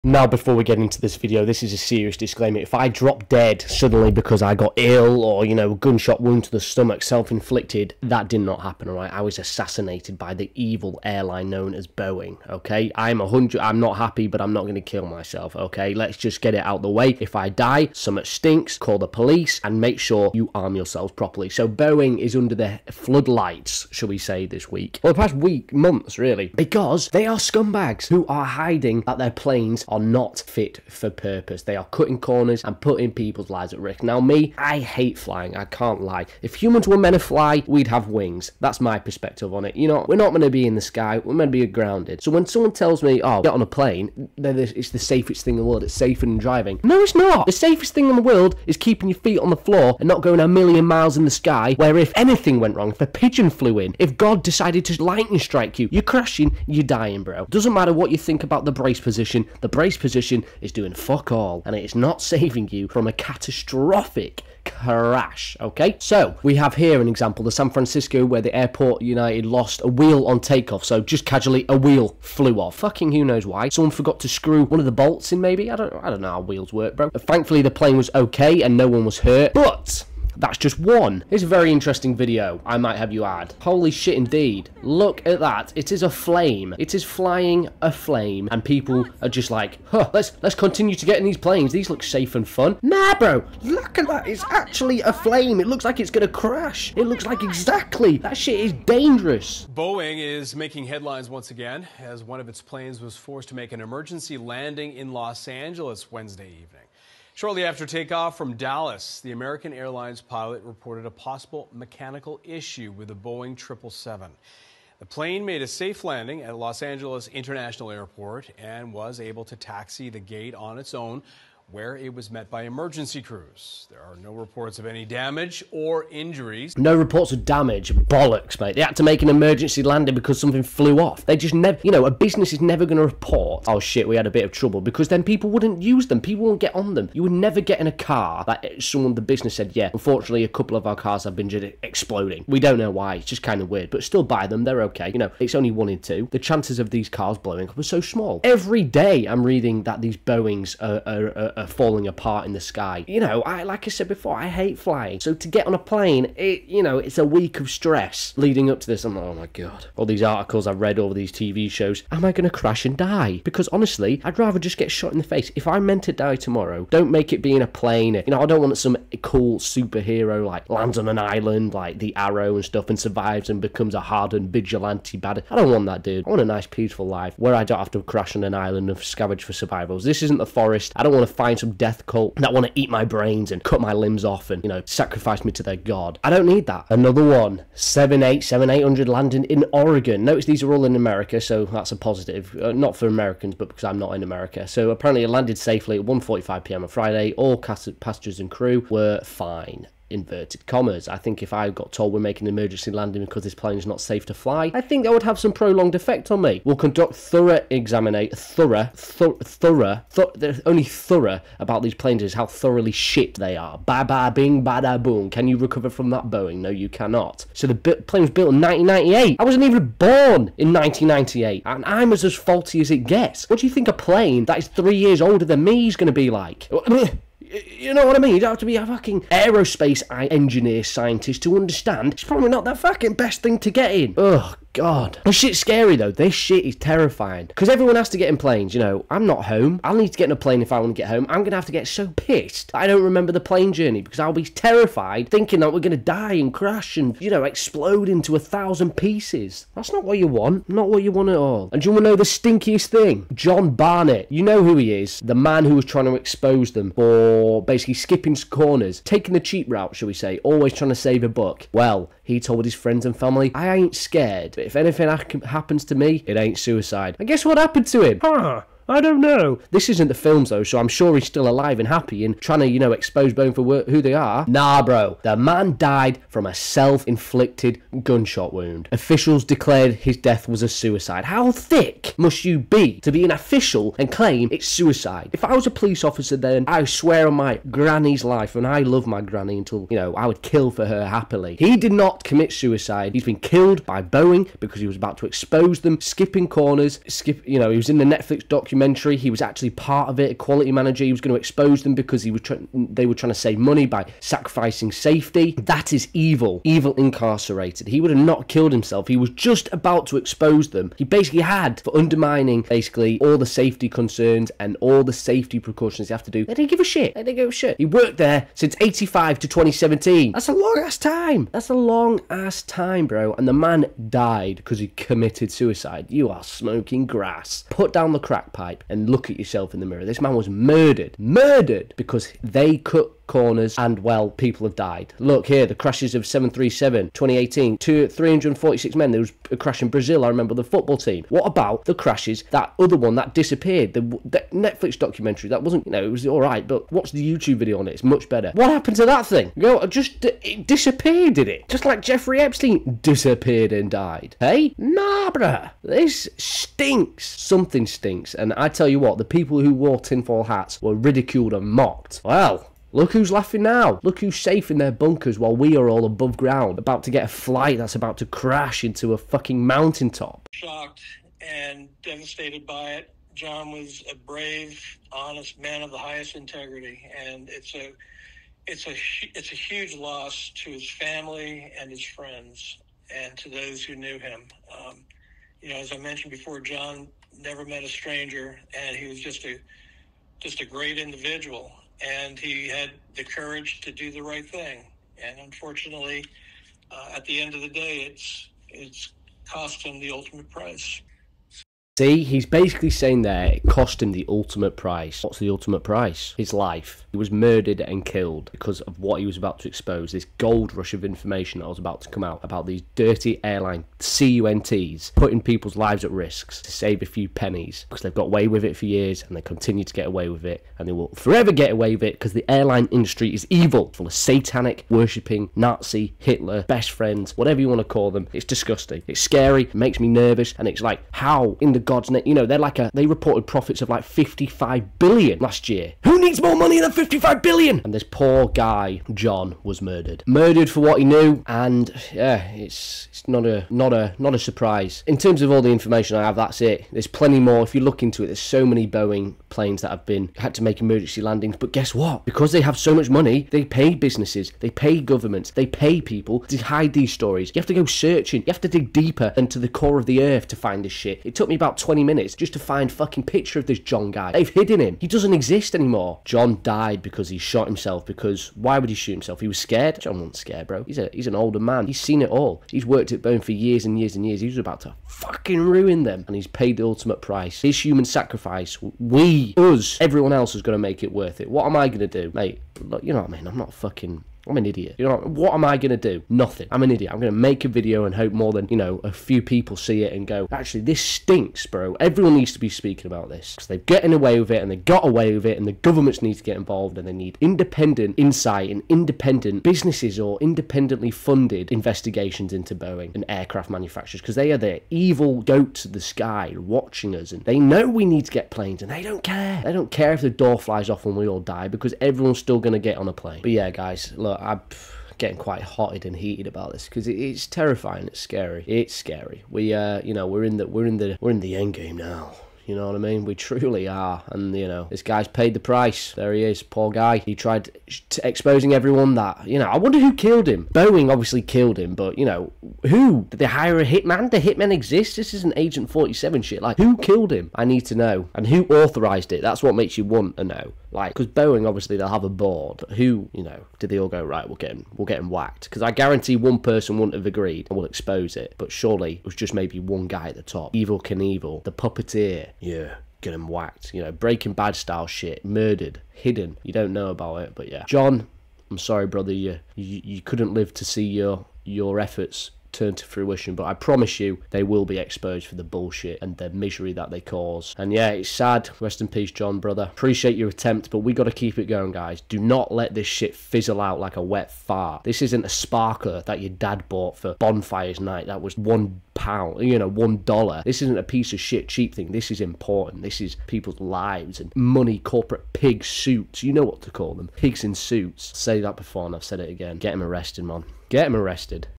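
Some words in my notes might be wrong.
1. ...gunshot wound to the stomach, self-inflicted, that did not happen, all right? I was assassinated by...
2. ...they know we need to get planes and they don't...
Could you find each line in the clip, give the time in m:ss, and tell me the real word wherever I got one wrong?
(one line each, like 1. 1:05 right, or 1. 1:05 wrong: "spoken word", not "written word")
1. 0:05 right
2. 8:27 right.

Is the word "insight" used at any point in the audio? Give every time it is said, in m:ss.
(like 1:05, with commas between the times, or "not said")
8:18.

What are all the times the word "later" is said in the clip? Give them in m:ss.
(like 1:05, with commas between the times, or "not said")
not said.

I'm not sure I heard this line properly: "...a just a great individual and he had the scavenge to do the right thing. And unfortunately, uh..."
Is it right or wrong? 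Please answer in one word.
wrong.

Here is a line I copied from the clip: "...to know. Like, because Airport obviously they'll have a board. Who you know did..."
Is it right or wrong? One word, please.
wrong.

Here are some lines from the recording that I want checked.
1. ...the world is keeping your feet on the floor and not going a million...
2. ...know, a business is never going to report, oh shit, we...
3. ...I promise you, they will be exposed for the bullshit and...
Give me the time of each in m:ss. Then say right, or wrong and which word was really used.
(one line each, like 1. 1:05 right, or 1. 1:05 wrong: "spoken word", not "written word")
1. 0:48 right
2. 2:11 right
3. 9:23 right.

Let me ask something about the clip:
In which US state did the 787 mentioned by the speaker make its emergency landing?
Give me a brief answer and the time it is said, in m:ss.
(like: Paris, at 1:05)
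Oregon, at 3:09.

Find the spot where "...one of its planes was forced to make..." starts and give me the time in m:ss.
1:42.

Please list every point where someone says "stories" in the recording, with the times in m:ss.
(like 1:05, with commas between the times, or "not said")
7:37.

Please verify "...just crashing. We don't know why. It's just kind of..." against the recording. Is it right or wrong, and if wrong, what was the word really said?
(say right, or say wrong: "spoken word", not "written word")
wrong: "exploding", not "crashing".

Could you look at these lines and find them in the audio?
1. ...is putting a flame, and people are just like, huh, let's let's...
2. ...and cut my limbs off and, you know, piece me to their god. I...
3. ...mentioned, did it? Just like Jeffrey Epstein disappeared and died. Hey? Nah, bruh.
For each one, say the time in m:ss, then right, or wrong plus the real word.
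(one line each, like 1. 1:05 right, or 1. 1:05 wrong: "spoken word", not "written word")
1. 1:26 wrong: "flying", not "putting"
2. 3:03 wrong: "sacrifice", not "piece"
3. 5:50 wrong: "disappeared", not "mentioned".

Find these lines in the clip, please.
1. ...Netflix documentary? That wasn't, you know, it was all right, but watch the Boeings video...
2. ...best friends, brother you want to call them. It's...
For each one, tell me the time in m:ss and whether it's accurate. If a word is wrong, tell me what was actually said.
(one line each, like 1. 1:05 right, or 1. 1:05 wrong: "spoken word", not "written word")
1. 5:44 wrong: "YouTube", not "Boeings"
2. 7:06 wrong: "whatever", not "brother".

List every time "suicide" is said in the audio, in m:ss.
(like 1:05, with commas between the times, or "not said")
4:26, 4:40, 4:44, 4:52, 5:25.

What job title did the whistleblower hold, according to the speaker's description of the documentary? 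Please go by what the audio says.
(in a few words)
quality manager.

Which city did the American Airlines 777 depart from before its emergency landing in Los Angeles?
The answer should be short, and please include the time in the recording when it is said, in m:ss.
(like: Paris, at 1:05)
Dallas, at 1:48.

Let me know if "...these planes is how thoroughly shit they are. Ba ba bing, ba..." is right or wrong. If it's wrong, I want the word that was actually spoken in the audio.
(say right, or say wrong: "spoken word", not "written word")
right.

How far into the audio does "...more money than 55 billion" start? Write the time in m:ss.
7:16.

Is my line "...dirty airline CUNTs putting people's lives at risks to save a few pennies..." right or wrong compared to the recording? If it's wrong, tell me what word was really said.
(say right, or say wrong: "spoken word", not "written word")
right.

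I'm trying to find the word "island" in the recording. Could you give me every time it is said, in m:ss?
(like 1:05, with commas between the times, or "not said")
2:51, 2:58.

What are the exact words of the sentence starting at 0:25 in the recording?
Well, the past week, months, really, because they are scumbags who are hiding that their planes are not fit for purpose.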